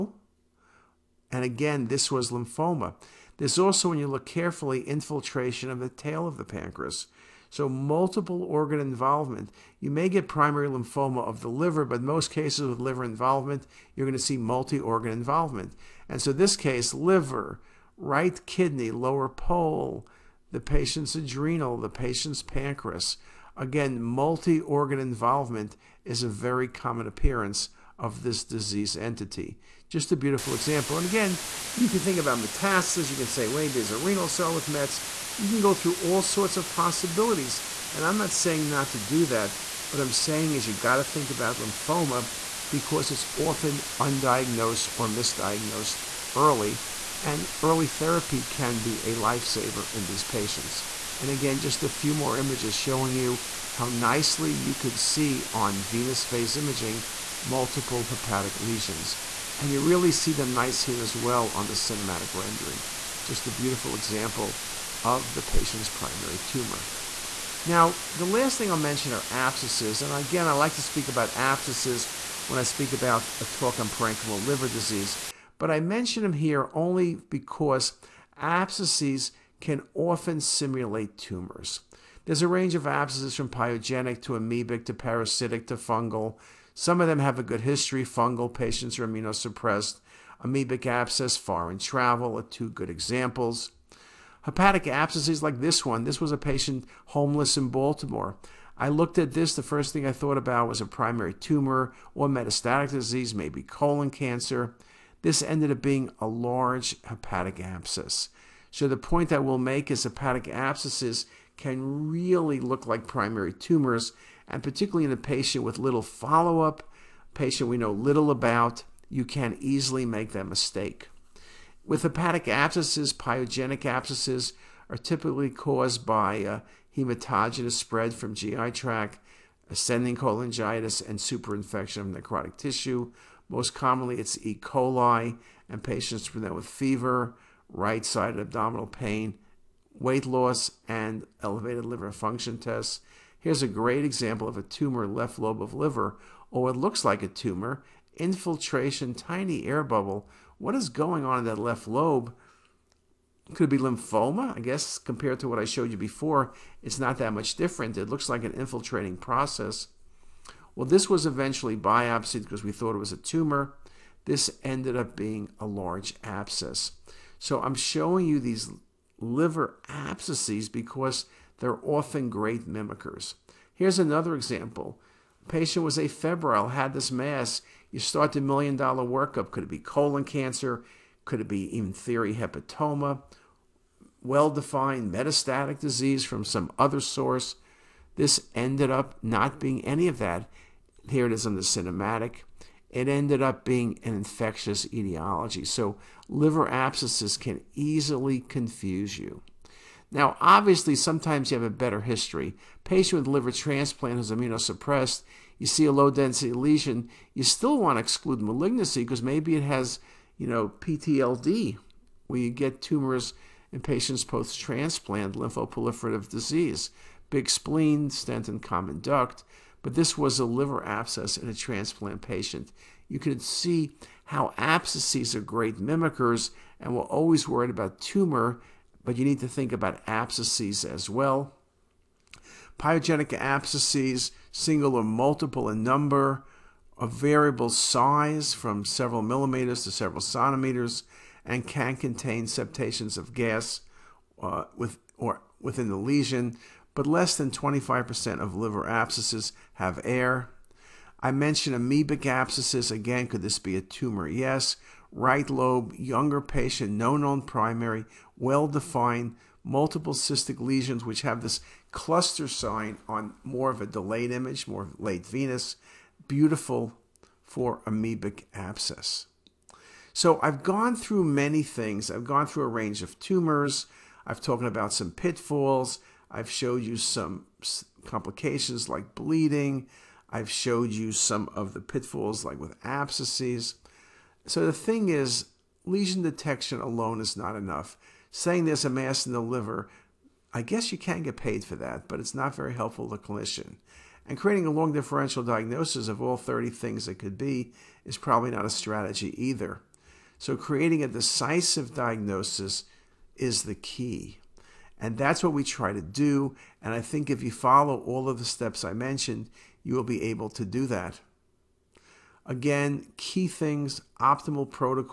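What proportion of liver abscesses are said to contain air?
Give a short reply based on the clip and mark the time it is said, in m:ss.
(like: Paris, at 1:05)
Less than 25%, at 4:07.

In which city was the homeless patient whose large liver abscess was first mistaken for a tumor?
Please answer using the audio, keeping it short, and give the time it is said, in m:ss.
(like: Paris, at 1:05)
Baltimore, at 1:37.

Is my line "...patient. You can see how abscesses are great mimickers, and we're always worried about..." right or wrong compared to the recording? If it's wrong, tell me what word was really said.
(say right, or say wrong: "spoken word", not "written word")
right.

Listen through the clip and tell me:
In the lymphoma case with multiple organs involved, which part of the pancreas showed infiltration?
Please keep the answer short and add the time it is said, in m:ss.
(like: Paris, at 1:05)
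The tail, at 0:05.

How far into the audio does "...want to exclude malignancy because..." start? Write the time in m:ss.
3:27.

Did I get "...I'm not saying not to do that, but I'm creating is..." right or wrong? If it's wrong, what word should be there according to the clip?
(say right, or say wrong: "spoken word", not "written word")
wrong: "saying", not "creating".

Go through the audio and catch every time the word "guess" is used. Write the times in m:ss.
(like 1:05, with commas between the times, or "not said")
2:34, 4:50.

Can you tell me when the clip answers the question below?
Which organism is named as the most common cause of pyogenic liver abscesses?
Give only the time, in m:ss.
2:14.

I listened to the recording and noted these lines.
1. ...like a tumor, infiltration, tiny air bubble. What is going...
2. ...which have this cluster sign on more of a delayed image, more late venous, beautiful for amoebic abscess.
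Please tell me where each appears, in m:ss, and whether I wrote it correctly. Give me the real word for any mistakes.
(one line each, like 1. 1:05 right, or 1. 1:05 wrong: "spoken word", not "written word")
1. 2:27 right
2. 4:21 right.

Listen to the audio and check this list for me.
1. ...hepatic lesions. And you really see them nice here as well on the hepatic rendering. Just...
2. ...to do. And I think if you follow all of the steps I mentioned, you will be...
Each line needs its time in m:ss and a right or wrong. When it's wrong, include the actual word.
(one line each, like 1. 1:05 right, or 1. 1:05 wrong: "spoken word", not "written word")
1. 0:58 wrong: "cinematic", not "hepatic"
2. 5:05 right.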